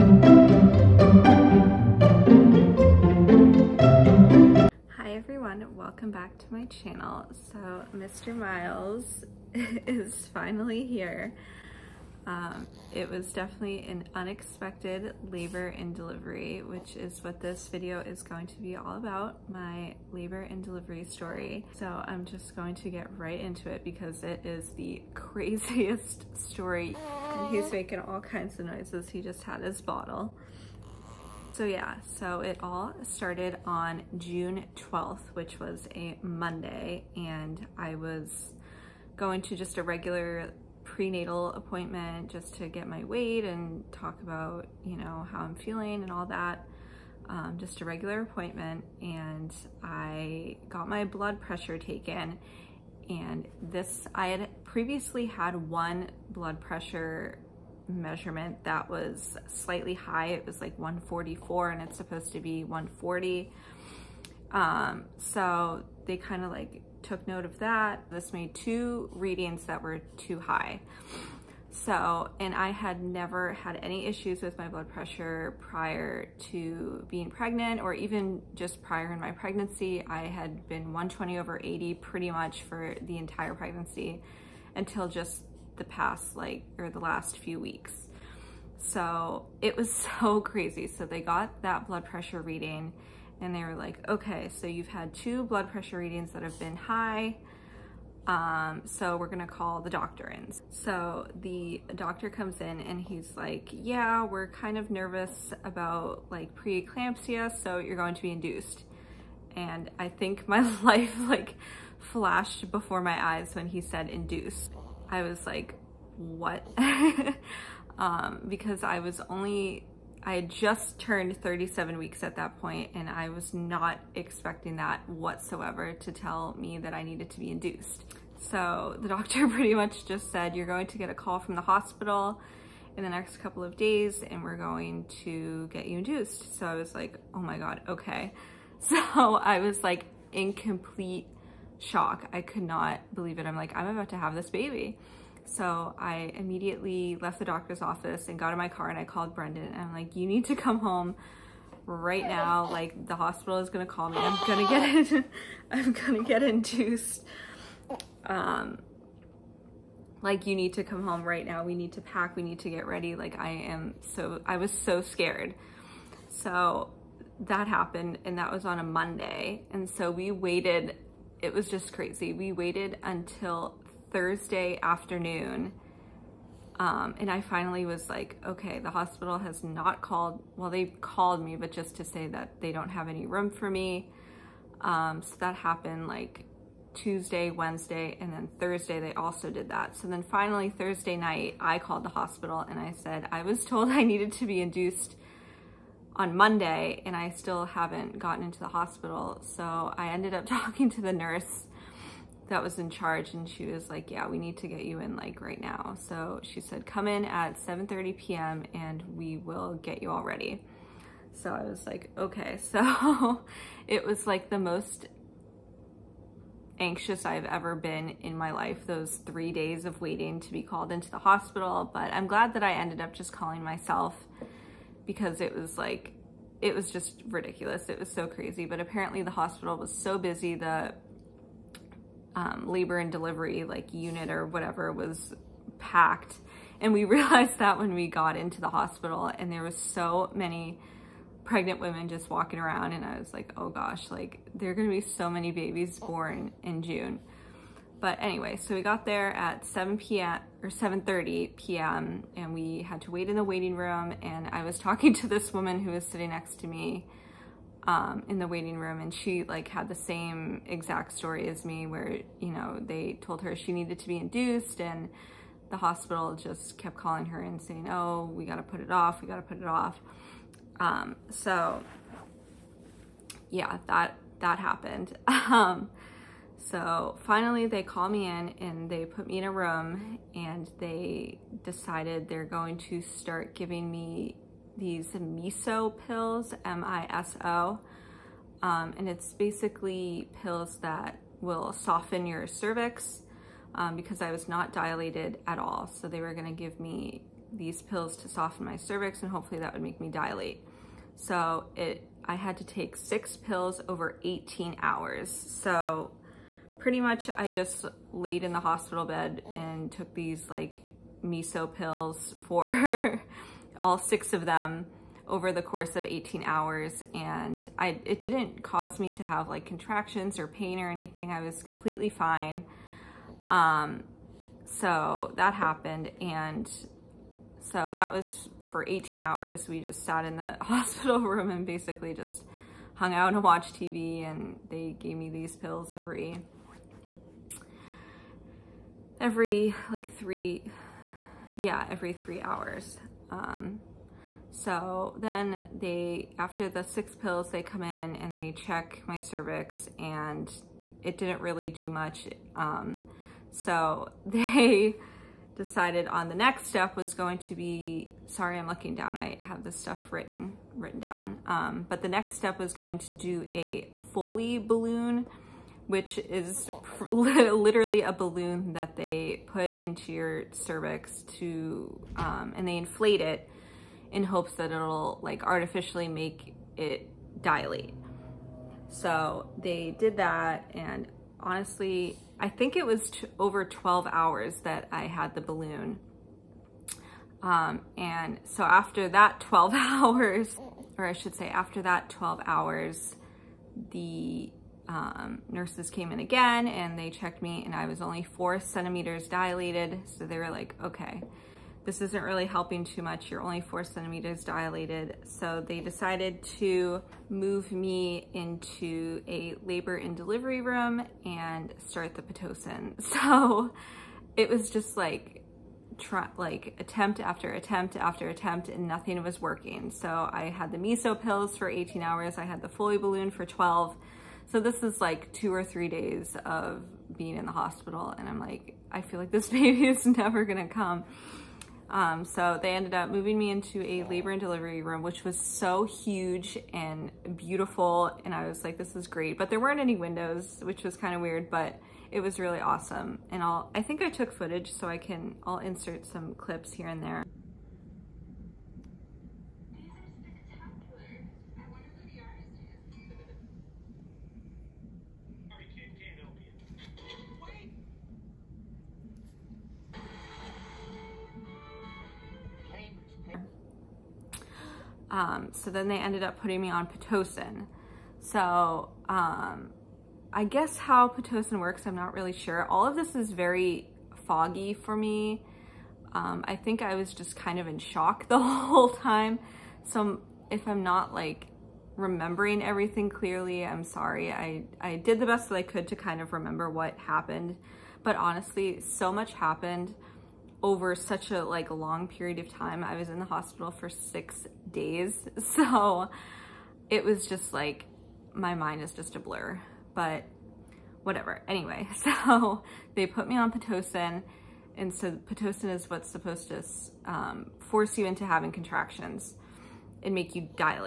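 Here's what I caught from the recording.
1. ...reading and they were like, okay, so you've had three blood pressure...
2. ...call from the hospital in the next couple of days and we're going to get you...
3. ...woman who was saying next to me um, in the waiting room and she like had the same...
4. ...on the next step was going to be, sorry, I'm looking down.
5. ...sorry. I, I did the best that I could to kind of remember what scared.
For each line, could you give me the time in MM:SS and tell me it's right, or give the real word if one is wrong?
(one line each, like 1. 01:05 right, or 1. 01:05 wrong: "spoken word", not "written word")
1. 01:32 wrong: "two", not "three"
2. 02:11 right
3. 04:15 wrong: "sitting", not "saying"
4. 05:56 right
5. 08:03 wrong: "happened", not "scared".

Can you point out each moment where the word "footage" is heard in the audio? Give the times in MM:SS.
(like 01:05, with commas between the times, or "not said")
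07:24.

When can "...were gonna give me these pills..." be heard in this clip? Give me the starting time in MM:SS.
04:56.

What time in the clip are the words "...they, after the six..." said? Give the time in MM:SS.
05:45.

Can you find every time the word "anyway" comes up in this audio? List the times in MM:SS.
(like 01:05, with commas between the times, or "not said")
04:08, 08:21.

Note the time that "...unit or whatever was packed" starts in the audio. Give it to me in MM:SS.
03:53.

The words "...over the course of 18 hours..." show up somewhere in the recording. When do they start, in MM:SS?
05:15.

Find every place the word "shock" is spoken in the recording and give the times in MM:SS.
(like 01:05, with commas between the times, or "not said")
02:21, 07:57.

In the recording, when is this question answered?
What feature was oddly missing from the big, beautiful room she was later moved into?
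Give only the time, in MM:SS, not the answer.
07:19.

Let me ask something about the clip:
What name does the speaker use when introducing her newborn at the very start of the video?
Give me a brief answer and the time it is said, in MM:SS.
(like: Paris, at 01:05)
Miles, at 00:08.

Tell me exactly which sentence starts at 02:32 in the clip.
Like the hospital is gonna call me.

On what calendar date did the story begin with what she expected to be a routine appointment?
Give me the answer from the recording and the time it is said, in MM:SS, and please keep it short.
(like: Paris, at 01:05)
June 12th, at 00:34.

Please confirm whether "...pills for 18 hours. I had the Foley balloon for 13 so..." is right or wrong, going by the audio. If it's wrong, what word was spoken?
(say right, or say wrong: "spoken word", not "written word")
wrong: "12", not "13".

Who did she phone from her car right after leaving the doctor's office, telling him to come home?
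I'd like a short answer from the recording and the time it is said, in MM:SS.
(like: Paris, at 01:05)
Brendan, at 02:29.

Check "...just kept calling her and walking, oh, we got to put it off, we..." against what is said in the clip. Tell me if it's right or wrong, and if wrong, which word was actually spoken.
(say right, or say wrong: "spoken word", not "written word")
wrong: "saying", not "walking".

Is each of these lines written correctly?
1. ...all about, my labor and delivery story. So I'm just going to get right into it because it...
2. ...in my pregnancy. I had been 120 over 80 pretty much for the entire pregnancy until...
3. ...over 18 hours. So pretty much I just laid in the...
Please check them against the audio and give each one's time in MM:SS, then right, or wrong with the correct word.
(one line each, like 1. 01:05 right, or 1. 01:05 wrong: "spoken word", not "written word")
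1. 00:18 right
2. 01:19 right
3. 05:03 right.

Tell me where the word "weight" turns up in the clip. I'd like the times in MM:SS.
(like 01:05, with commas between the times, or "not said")
00:43.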